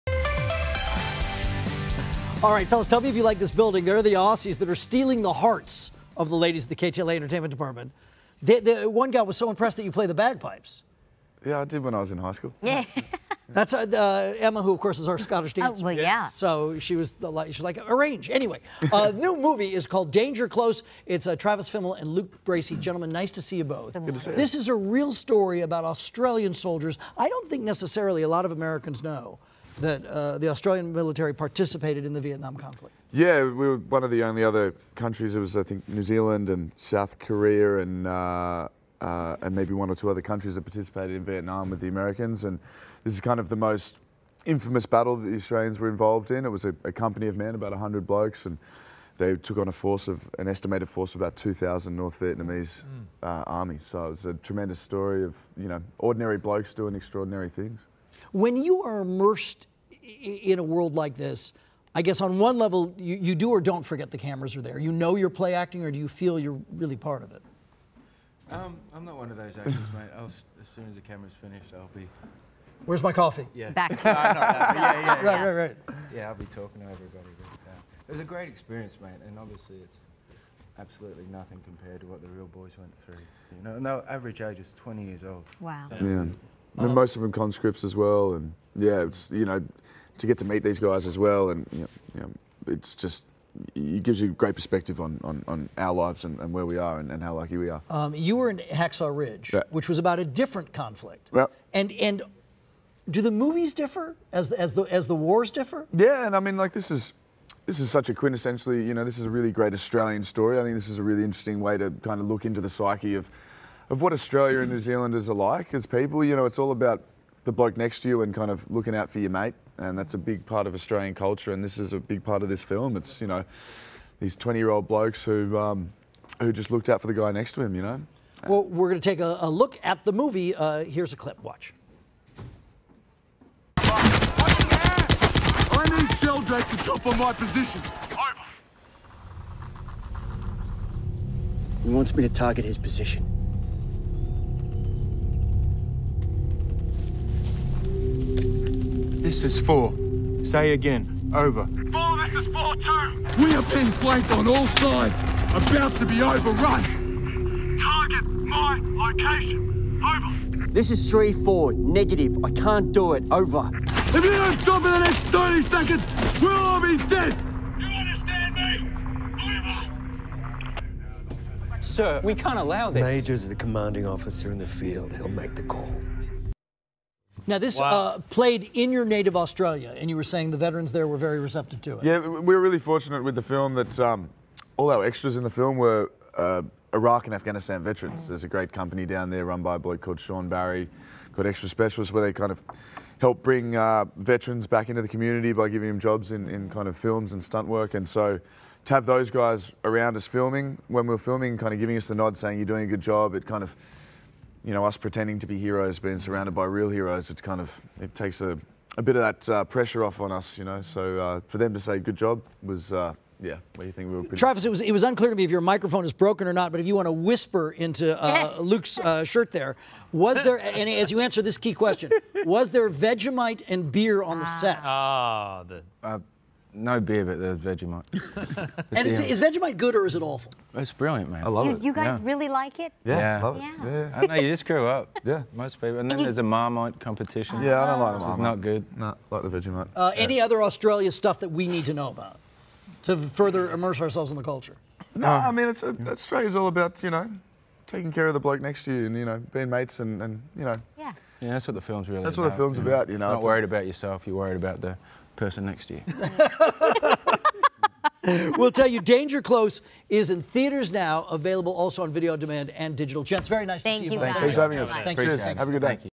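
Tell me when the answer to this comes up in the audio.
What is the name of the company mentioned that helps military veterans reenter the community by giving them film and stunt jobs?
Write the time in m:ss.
3:11.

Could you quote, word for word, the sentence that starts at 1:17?
But, uh, it was a great experience, mate, and obviously it's absolutely nothing compared to what the real boys went through.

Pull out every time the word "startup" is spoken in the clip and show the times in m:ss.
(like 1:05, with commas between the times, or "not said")
not said.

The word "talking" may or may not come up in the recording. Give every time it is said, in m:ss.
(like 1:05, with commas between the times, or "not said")
1:16.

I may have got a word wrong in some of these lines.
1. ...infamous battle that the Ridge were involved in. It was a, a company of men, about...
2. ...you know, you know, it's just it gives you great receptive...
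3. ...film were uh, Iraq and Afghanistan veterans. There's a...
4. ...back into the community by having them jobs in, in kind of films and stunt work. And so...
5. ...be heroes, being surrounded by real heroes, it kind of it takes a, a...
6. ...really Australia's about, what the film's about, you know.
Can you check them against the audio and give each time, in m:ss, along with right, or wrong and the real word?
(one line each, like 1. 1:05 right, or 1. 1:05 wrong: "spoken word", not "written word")
1. 0:44 wrong: "Australians", not "Ridge"
2. 1:31 wrong: "perspective", not "receptive"
3. 3:05 right
4. 3:14 wrong: "giving", not "having"
5. 3:25 right
6. 4:12 wrong: "That", not "Australia".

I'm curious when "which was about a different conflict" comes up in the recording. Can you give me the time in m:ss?
1:39.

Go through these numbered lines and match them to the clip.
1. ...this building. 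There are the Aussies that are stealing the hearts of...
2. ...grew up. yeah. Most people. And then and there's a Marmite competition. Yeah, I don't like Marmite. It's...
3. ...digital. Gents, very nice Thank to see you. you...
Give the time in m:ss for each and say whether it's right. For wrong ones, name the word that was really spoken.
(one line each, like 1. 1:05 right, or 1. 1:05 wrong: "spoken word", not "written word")
1. 0:03 right
2. 3:54 right
3. 4:22 right.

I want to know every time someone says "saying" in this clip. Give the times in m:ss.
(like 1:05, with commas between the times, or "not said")
3:00, 3:22.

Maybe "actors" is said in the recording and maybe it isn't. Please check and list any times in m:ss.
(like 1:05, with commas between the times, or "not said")
1:09.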